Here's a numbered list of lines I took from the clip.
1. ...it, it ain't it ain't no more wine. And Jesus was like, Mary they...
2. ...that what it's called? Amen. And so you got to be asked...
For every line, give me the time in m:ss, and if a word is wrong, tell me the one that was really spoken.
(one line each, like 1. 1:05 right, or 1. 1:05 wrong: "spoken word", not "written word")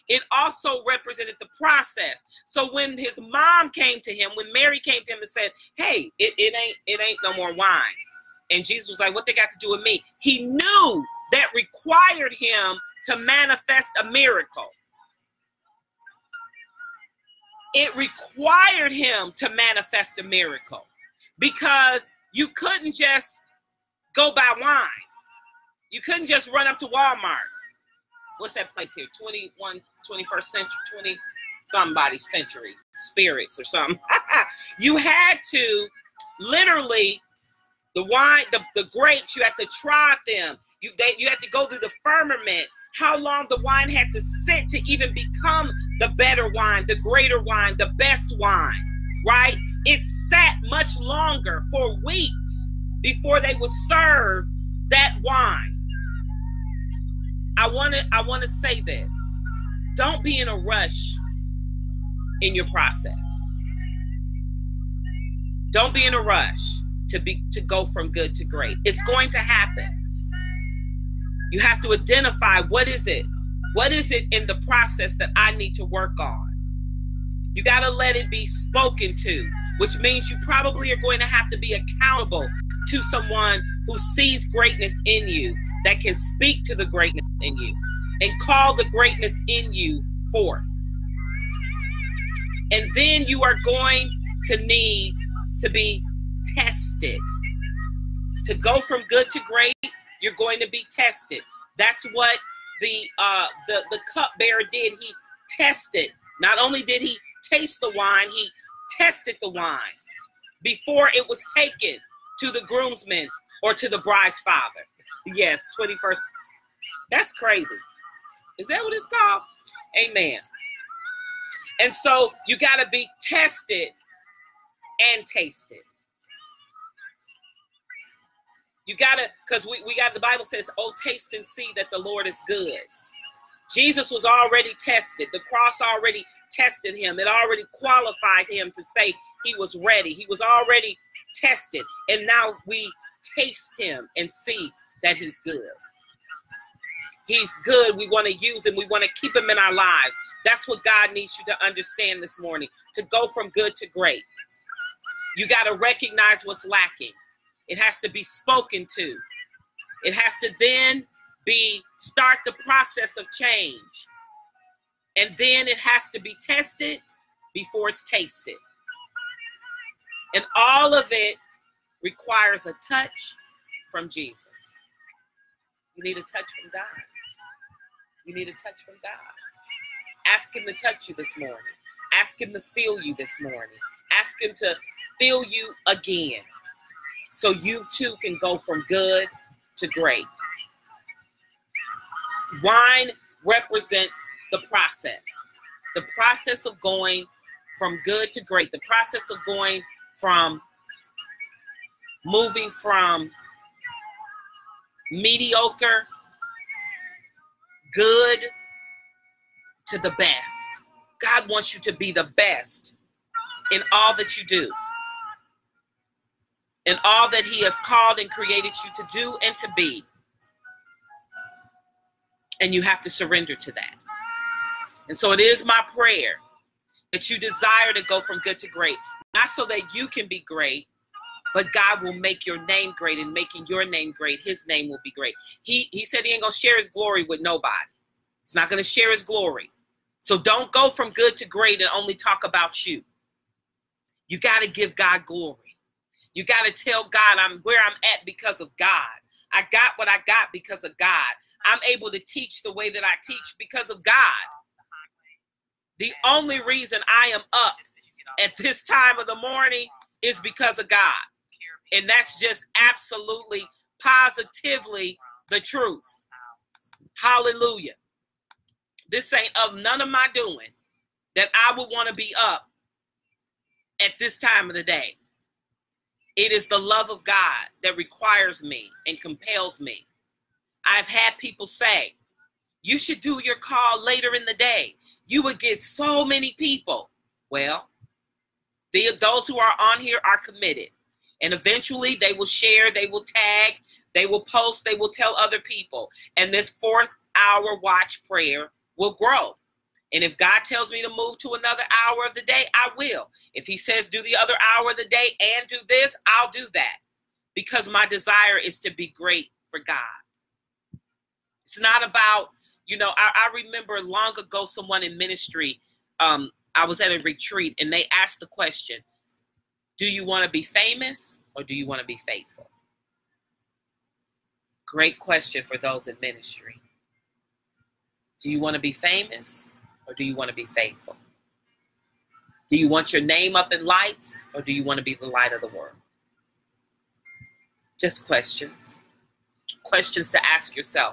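1. 0:06 wrong: "What", not "Mary"
2. 1:58 wrong: "tested", not "asked".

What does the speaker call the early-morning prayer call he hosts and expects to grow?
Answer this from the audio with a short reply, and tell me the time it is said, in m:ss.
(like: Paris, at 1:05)
fourth hour watch prayer, at 4:56.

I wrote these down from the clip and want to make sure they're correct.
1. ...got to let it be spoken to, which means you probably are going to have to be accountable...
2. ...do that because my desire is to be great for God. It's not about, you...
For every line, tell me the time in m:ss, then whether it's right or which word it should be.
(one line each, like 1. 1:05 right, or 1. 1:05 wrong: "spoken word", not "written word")
1. 1:17 right
2. 5:06 right.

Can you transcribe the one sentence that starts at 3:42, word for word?
And you have to surrender to that.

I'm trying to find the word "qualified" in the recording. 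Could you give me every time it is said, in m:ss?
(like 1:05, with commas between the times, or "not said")
2:17.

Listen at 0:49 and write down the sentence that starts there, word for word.
It sat much longer for weeks before they would serve that wine.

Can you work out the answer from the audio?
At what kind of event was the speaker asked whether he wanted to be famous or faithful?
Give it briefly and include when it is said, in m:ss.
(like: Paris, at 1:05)
a retreat, at 5:17.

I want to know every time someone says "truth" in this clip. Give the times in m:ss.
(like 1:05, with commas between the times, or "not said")
4:25.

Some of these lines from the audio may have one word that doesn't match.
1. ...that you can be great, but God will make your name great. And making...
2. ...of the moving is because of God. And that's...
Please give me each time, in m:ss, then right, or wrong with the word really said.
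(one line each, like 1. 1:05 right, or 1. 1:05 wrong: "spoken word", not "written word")
1. 3:49 right
2. 4:19 wrong: "morning", not "moving".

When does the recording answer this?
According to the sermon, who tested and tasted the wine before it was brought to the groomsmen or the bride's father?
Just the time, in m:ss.
1:44.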